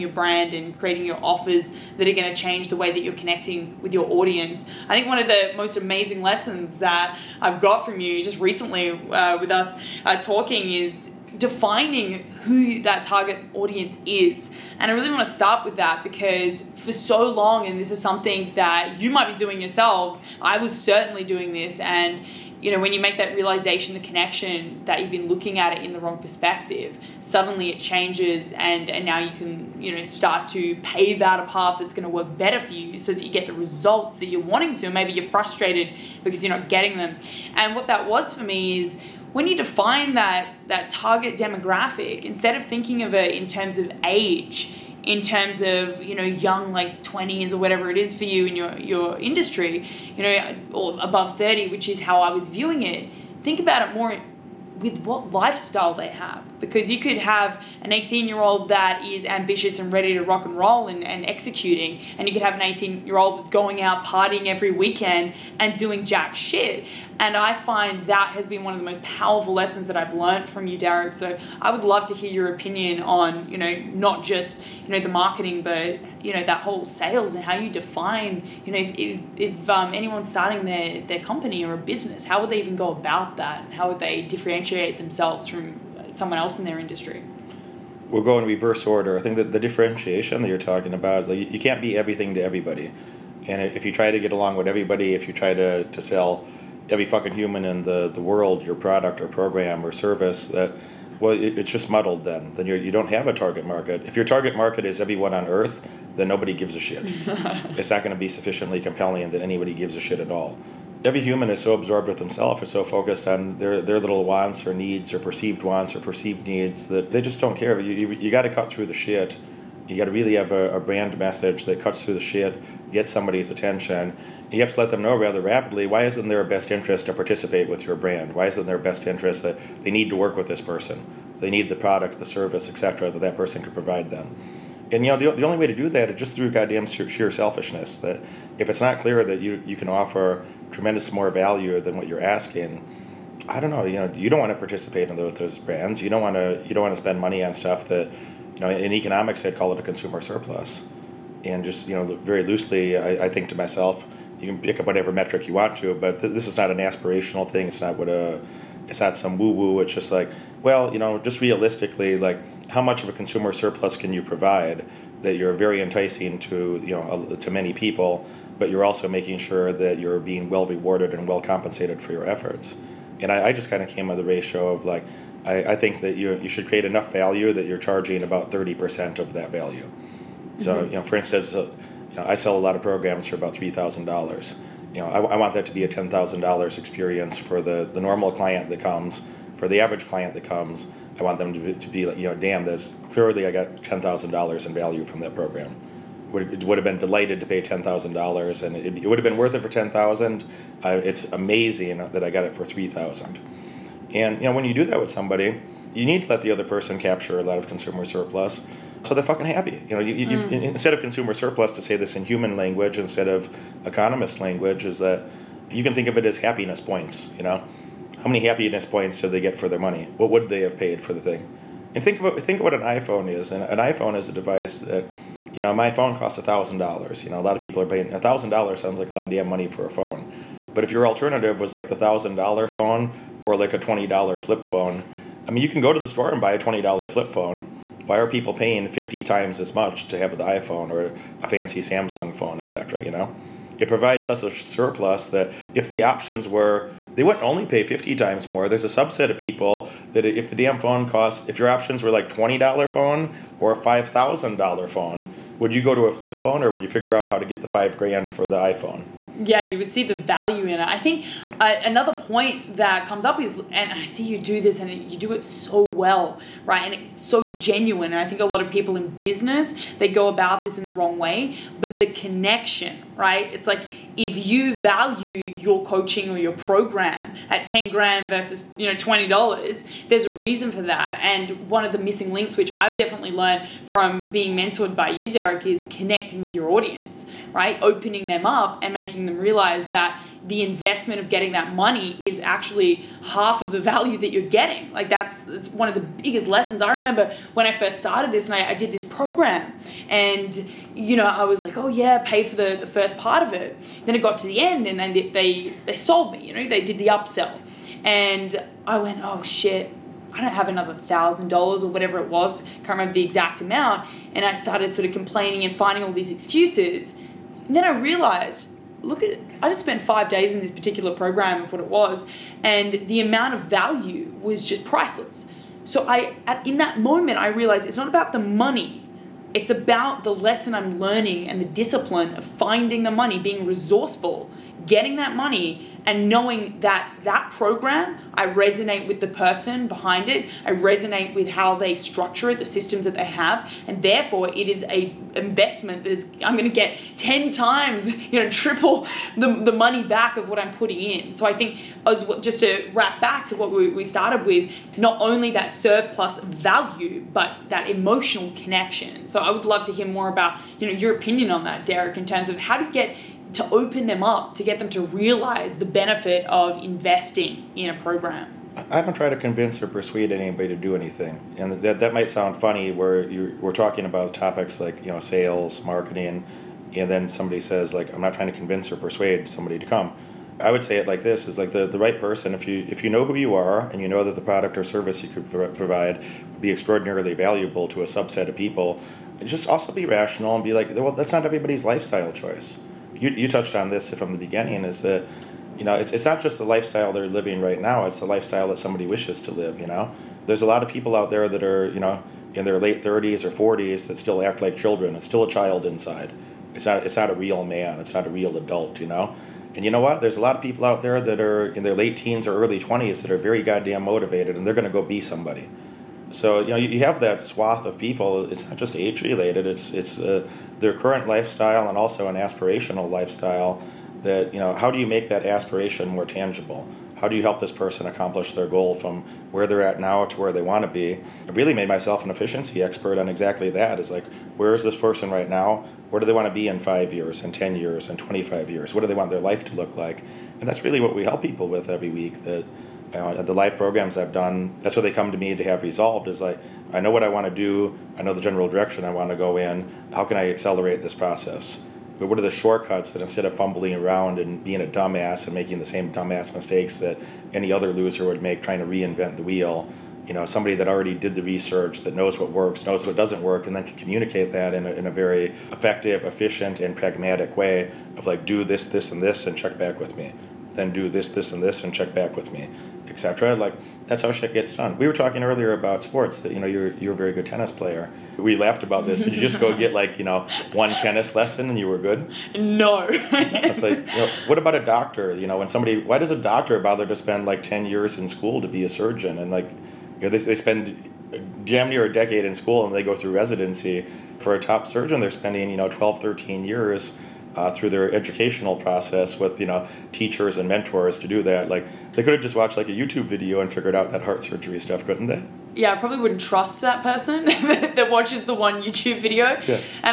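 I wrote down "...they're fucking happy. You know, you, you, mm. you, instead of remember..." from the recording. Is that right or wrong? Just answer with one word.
wrong.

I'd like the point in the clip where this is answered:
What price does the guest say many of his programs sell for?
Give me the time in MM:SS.
03:03.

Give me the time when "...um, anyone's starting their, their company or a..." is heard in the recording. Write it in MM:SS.
01:19.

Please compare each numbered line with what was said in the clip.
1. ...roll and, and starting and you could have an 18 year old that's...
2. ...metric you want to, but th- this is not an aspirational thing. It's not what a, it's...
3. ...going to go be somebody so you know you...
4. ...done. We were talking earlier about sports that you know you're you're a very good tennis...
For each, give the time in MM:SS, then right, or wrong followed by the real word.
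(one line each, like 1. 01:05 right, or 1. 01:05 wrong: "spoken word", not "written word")
1. 01:00 wrong: "executing", not "starting"
2. 02:35 right
3. 06:54 right
4. 07:54 right.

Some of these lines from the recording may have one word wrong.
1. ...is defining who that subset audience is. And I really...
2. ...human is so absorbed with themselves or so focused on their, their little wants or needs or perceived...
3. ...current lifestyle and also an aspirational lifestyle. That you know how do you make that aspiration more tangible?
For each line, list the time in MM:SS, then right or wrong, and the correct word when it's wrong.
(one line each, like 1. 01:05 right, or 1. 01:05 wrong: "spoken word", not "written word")
1. 00:10 wrong: "target", not "subset"
2. 01:51 right
3. 07:00 right.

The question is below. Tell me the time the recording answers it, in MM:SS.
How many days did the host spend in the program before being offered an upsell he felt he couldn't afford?
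05:20.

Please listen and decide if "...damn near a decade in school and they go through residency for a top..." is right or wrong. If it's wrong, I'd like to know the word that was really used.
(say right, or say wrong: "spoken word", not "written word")
right.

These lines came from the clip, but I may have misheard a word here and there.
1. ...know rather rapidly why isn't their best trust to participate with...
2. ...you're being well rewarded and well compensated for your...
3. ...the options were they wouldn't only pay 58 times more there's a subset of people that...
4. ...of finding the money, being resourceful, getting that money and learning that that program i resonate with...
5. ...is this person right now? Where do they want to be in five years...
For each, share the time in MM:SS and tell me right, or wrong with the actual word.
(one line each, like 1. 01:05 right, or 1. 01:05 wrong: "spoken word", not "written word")
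1. 02:05 wrong: "interest", not "trust"
2. 02:49 right
3. 04:05 wrong: "50", not "58"
4. 05:32 wrong: "knowing", not "learning"
5. 07:14 right.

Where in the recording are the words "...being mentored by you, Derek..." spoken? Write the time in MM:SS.
04:44.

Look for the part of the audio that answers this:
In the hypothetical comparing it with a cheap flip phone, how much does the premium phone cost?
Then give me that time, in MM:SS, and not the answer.
04:13.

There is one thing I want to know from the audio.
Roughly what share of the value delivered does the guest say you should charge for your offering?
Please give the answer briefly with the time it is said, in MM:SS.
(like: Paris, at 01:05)
30%, at 02:58.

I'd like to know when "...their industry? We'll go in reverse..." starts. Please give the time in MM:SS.
01:26.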